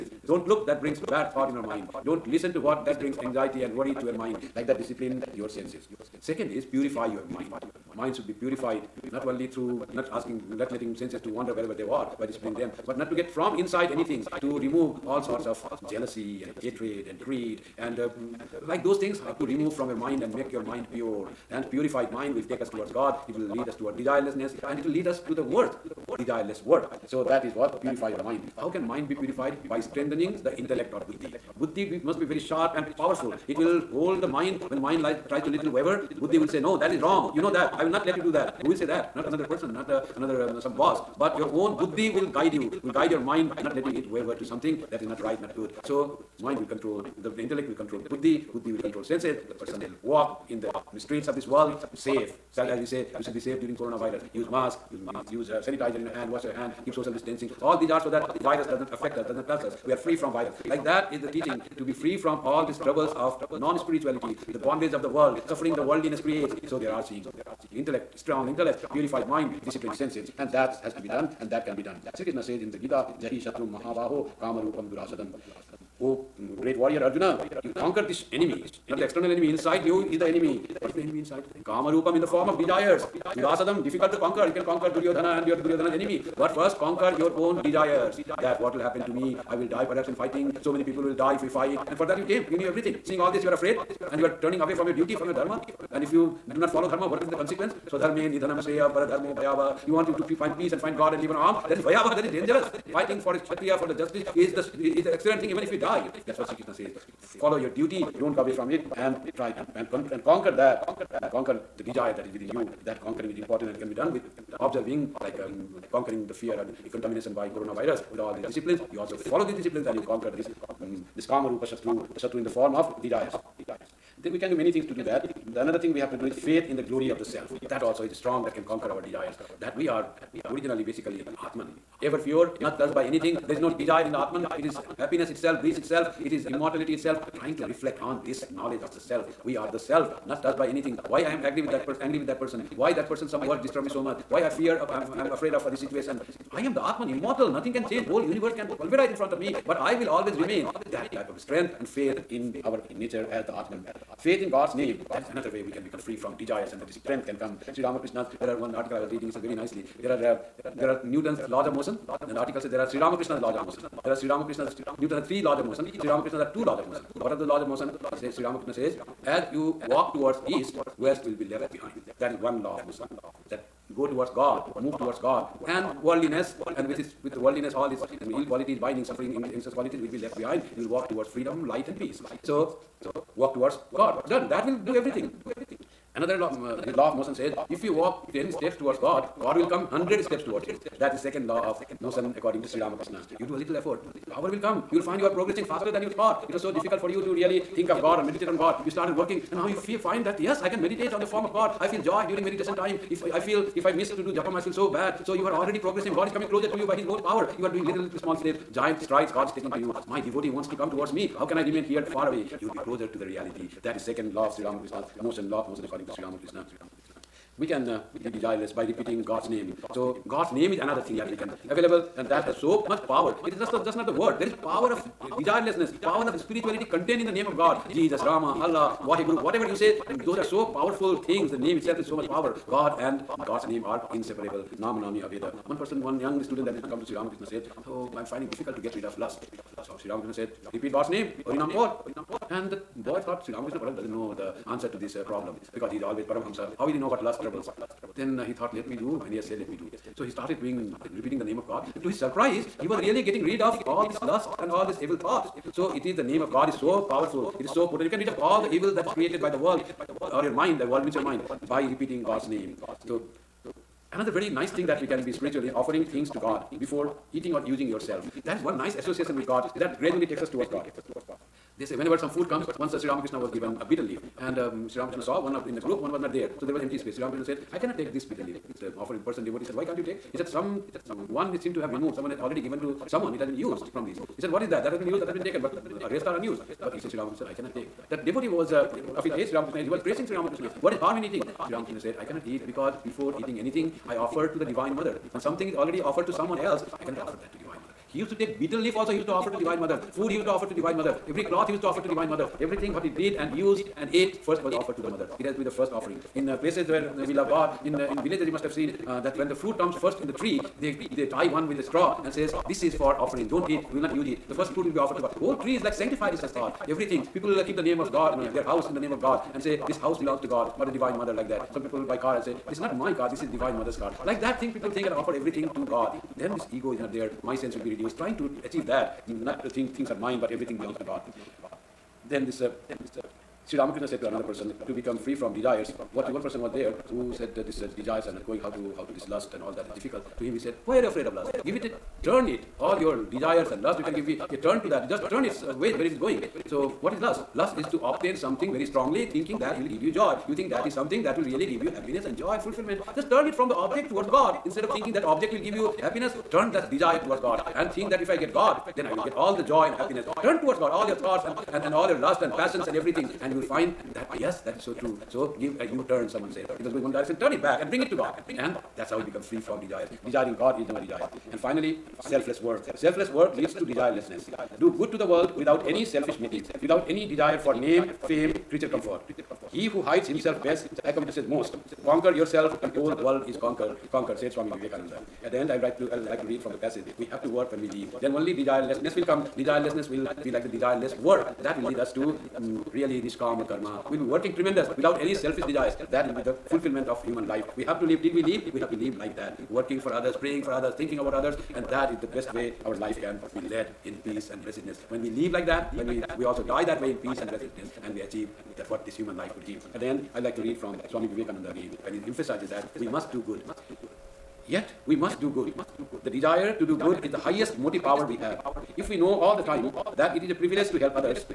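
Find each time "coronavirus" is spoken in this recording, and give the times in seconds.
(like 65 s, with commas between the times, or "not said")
53 s, 117 s.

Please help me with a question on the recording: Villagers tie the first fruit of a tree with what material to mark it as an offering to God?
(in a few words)
Straw.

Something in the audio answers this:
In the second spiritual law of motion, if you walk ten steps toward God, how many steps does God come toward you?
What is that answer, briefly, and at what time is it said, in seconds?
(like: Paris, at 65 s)
100, at 189 s.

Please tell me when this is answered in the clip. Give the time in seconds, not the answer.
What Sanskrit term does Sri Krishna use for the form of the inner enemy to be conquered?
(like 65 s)
81 s.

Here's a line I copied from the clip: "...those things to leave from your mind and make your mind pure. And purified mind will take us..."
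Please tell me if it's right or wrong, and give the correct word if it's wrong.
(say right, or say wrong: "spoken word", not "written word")
wrong: "remove", not "leave".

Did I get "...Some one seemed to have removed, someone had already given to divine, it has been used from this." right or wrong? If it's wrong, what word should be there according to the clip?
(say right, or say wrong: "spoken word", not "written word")
wrong: "someone", not "divine".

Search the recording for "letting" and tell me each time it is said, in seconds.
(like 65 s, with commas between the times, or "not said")
10 s, 43 s.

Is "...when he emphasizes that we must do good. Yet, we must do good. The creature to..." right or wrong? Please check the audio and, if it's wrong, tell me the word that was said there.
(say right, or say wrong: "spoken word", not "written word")
wrong: "desire", not "creature".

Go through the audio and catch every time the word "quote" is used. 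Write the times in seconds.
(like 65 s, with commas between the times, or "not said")
not said.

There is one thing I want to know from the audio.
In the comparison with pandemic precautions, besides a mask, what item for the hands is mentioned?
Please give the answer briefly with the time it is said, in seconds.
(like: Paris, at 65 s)
Sanitizer, at 55 s.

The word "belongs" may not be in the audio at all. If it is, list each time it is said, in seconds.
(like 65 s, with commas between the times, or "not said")
320 s, 330 s.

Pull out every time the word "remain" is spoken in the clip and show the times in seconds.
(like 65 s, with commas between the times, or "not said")
150 s, 211 s.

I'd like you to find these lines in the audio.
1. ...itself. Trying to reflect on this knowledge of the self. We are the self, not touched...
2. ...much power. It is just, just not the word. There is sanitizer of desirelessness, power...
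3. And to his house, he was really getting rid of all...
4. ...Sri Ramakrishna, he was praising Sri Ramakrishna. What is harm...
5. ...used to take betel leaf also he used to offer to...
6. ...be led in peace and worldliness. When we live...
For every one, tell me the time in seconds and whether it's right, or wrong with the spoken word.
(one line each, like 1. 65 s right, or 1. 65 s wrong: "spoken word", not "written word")
1. 136 s right
2. 222 s wrong: "power", not "sanitizer"
3. 251 s wrong: "surprise", not "house"
4. 289 s right
5. 298 s right
6. 403 s wrong: "blessedness", not "worldliness".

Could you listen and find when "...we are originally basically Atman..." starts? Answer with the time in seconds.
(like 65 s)
129 s.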